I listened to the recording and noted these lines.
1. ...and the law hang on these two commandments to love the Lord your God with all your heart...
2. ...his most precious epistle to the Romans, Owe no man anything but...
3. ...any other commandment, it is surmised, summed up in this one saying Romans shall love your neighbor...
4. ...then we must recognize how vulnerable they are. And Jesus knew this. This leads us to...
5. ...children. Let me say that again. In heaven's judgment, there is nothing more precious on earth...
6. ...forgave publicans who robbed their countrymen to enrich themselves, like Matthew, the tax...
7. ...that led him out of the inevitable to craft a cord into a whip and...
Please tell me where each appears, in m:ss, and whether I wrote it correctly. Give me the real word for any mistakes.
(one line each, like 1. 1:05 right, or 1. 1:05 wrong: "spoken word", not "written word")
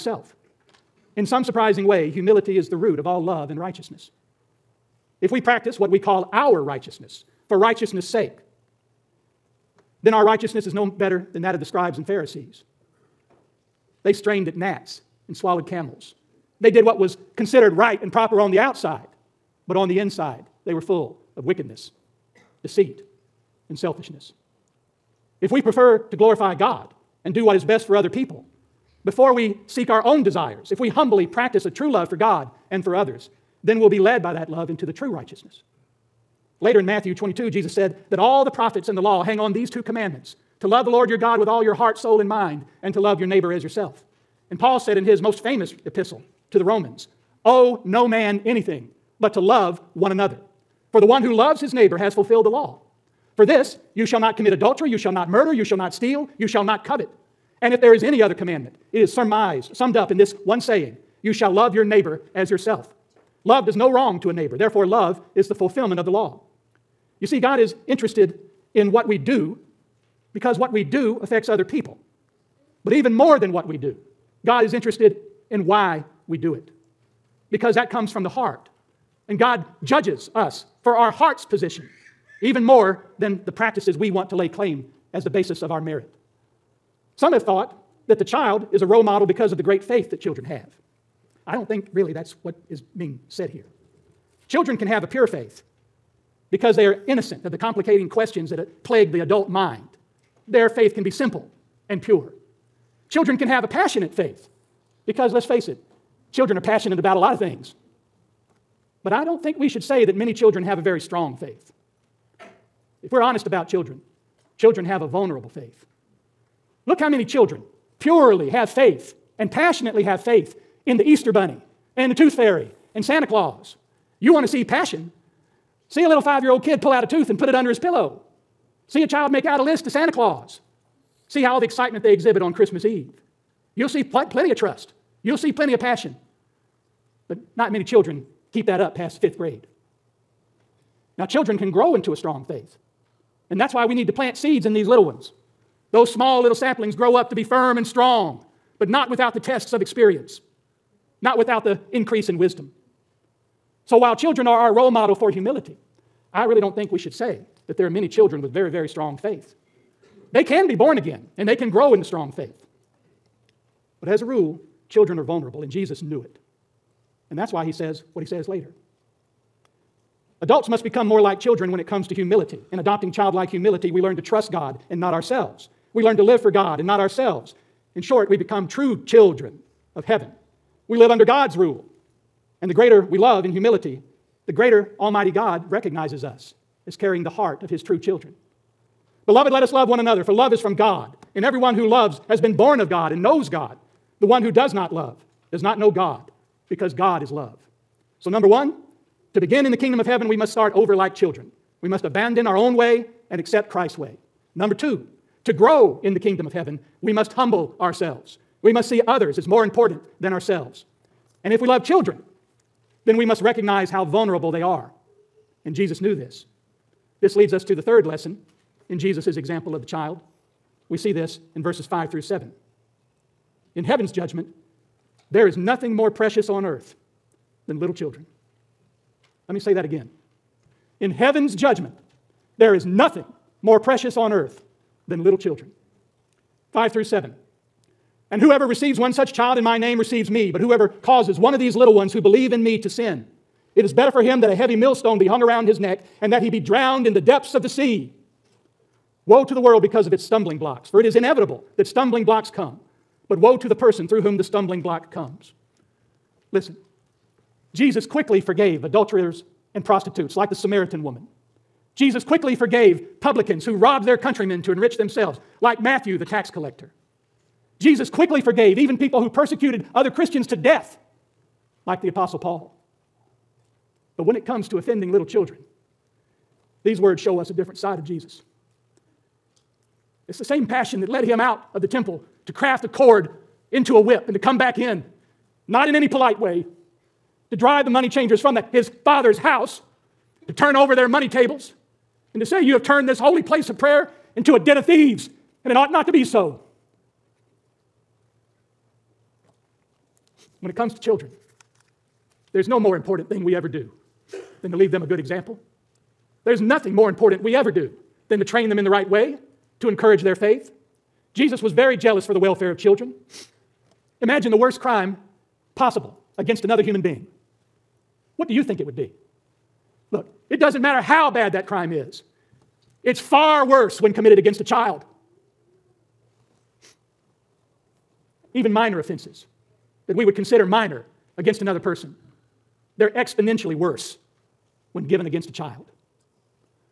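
1. 0:38 right
2. 0:45 wrong: "famous", not "precious"
3. 0:58 wrong: "You", not "Romans"
4. 3:33 right
5. 3:47 right
6. 4:22 right
7. 4:41 wrong: "temple", not "inevitable".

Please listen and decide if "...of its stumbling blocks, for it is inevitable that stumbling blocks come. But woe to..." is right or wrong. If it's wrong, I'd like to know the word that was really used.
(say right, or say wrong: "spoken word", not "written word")
right.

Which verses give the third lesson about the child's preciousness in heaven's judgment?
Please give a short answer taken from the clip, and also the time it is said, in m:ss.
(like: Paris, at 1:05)
verses 5 through 7, at 3:41.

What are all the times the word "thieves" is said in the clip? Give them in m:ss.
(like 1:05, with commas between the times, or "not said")
4:54.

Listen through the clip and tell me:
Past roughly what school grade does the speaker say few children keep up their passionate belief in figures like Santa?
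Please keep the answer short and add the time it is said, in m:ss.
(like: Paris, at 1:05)
fifth grade, at 2:19.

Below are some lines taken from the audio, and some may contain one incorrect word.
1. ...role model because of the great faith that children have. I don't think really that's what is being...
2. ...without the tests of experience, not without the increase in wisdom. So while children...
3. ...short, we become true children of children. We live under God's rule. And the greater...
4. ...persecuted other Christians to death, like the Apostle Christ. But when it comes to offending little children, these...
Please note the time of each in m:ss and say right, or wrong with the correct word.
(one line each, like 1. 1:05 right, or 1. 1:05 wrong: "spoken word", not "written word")
1. 1:28 right
2. 2:29 right
3. 2:58 wrong: "heaven", not "children"
4. 4:29 wrong: "Paul", not "Christ".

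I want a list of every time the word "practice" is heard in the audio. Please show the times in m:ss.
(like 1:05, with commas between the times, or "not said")
0:05, 0:31, 1:23.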